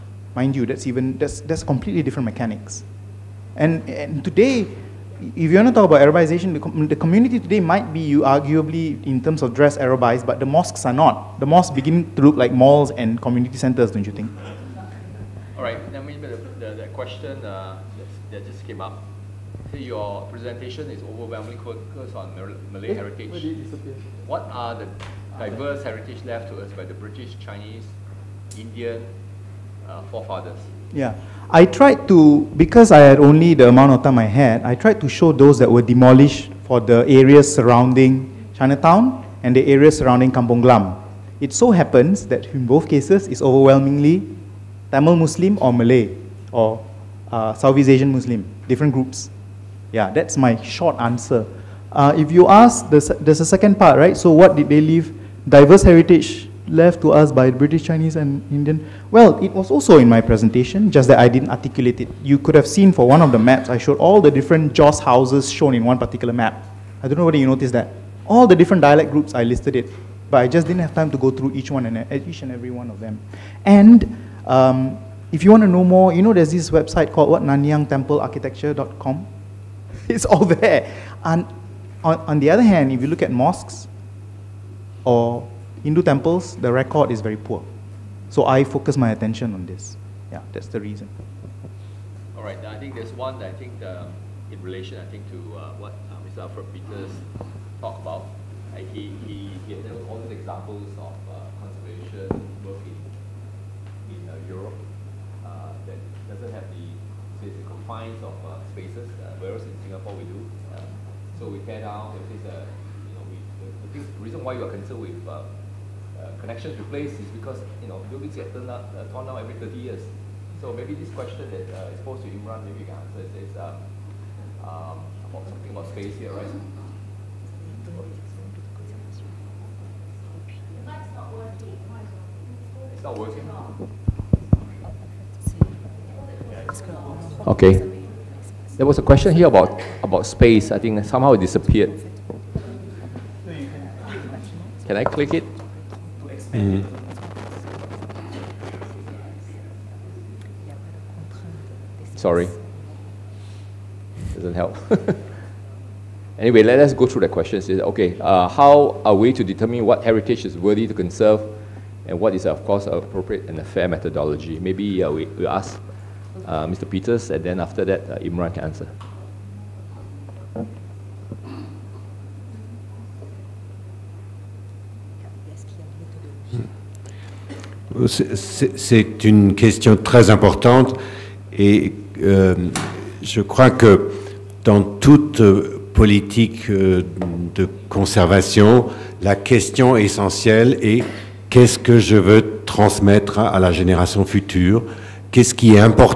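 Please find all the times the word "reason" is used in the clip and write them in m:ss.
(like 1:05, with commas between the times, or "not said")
1:30, 1:54.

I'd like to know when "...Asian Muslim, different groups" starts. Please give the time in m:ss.
0:47.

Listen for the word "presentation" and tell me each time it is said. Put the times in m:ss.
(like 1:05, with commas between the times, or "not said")
0:20, 1:00.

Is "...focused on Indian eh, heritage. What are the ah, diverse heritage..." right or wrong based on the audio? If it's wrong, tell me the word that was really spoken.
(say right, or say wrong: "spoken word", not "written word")
wrong: "Malay", not "Indian".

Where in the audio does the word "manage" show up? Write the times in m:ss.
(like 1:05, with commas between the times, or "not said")
not said.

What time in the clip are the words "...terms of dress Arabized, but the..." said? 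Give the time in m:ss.
0:09.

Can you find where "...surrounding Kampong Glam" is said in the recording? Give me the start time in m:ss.
0:39.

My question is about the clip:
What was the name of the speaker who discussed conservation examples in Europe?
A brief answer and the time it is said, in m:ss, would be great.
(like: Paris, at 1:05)
Alfred Peters, at 1:36.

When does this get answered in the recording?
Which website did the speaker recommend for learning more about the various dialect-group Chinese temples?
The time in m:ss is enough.
1:17.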